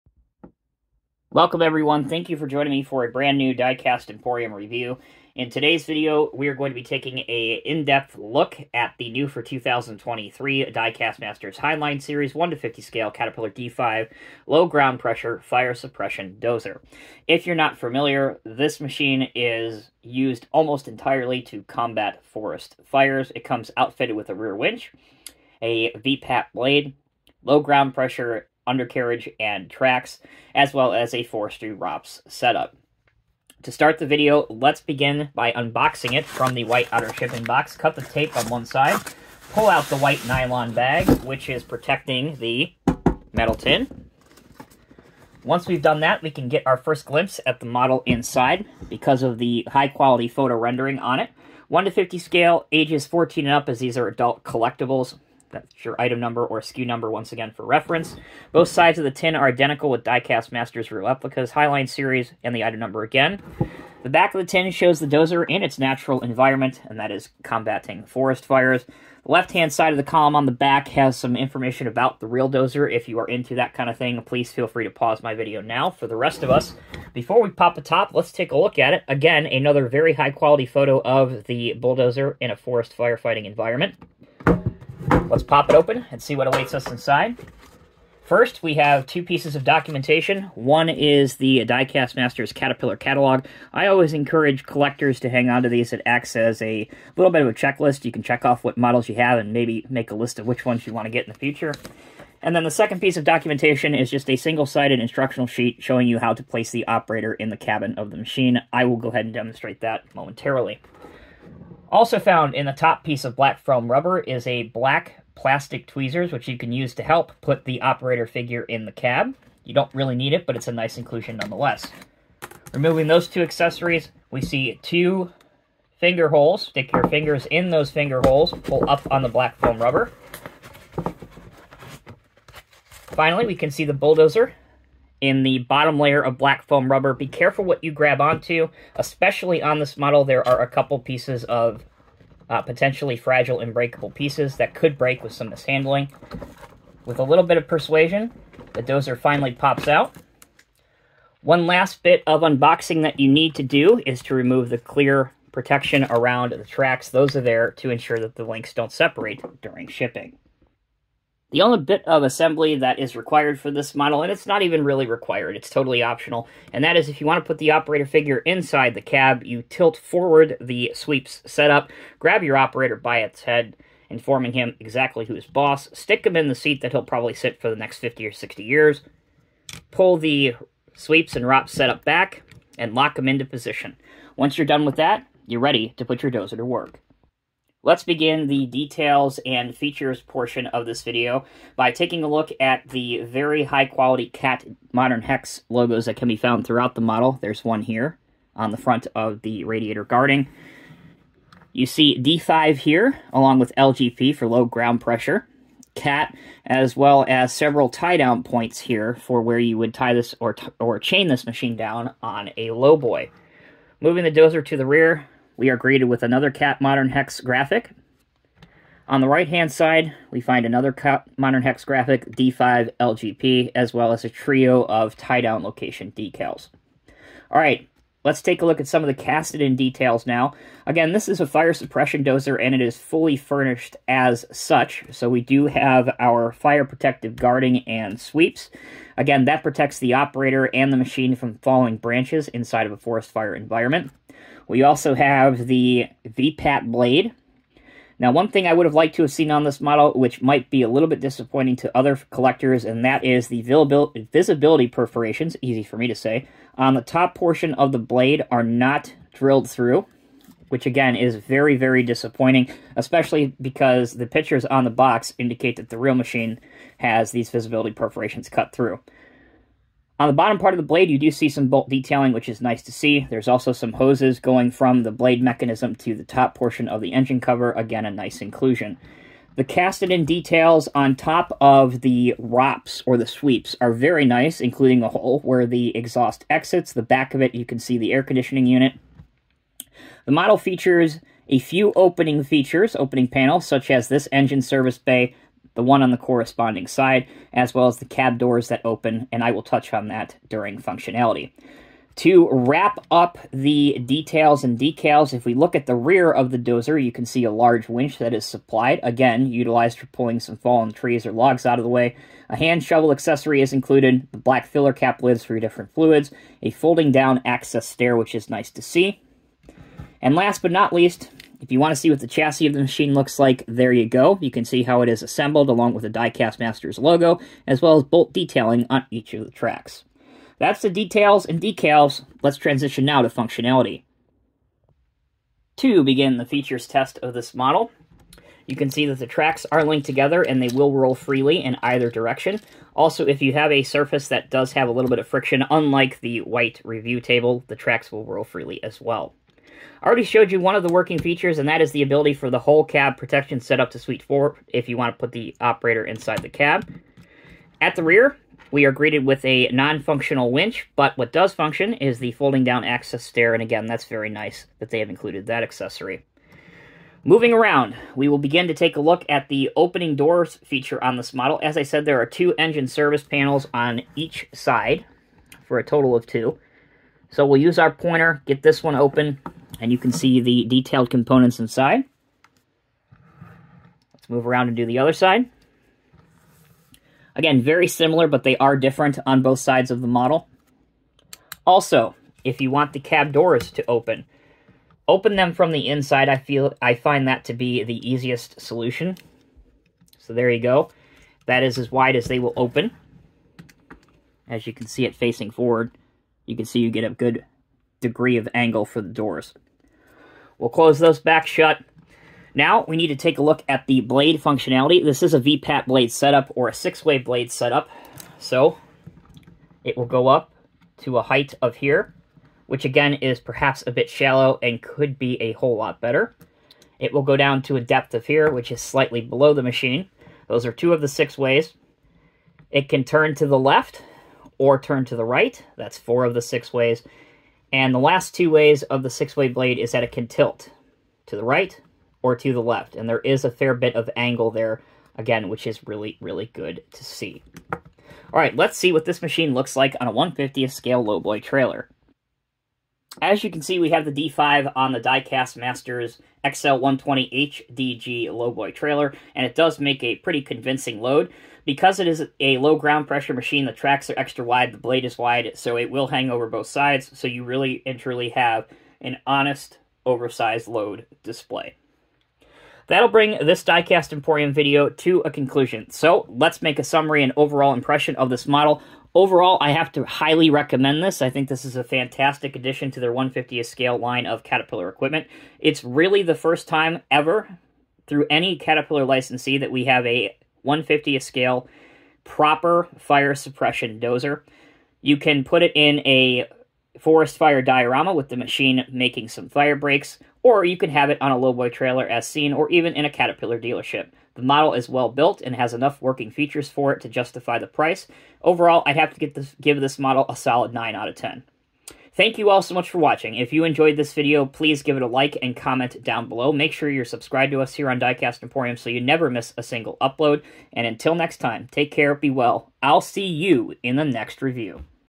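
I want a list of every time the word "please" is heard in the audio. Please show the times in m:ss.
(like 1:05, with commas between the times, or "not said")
1:14, 8:34.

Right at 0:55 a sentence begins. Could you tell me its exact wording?
That's your item number or SKU number once again for reference.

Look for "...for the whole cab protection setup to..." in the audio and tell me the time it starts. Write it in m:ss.
5:52.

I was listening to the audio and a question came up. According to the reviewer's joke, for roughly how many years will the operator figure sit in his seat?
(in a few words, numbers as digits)
50 or 60 years.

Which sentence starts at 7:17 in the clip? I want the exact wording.
And the last two ways of the six-blade blade is that it can tilt to the right or to the left.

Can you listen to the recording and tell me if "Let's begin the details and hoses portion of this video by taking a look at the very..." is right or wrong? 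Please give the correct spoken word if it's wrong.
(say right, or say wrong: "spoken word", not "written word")
wrong: "features", not "hoses".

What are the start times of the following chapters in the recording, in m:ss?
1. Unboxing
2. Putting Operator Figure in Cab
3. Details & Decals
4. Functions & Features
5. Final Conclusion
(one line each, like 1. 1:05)
1. 0:35
2. 2:40
3. 3:07
4. 5:34
5. 7:53.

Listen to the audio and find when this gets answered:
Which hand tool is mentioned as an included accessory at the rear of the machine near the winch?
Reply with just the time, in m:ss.
5:12.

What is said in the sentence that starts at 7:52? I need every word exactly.
That'll bring this Diecast Emporium video to a conclusion.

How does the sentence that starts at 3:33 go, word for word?
Moving the dozer to the rear, we are greeted with another Cat Modern Hex graphic.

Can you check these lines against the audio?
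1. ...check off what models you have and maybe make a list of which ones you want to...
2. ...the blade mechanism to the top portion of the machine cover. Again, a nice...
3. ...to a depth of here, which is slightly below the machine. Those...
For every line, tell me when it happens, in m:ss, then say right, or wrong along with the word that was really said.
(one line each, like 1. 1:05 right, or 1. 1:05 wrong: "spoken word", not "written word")
1. 1:38 right
2. 4:35 wrong: "engine", not "machine"
3. 7:07 right.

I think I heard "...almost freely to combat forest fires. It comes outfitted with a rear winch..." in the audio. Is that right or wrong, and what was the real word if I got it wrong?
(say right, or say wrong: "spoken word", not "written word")
wrong: "entirely", not "freely".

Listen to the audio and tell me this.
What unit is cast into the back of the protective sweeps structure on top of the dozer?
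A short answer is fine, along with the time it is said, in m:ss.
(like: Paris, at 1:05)
Air conditioning unit, at 4:48.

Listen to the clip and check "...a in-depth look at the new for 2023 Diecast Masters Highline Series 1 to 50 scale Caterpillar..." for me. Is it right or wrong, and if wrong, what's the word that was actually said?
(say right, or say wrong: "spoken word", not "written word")
right.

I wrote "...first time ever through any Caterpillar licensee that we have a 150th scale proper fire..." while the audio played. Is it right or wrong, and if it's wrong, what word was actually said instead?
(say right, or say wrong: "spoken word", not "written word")
right.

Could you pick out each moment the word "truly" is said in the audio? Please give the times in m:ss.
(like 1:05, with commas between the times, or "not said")
7:47.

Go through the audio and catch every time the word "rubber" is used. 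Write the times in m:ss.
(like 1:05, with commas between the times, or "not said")
1:53, 2:09, 2:16.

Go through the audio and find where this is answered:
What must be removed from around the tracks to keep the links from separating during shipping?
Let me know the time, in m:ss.
2:34.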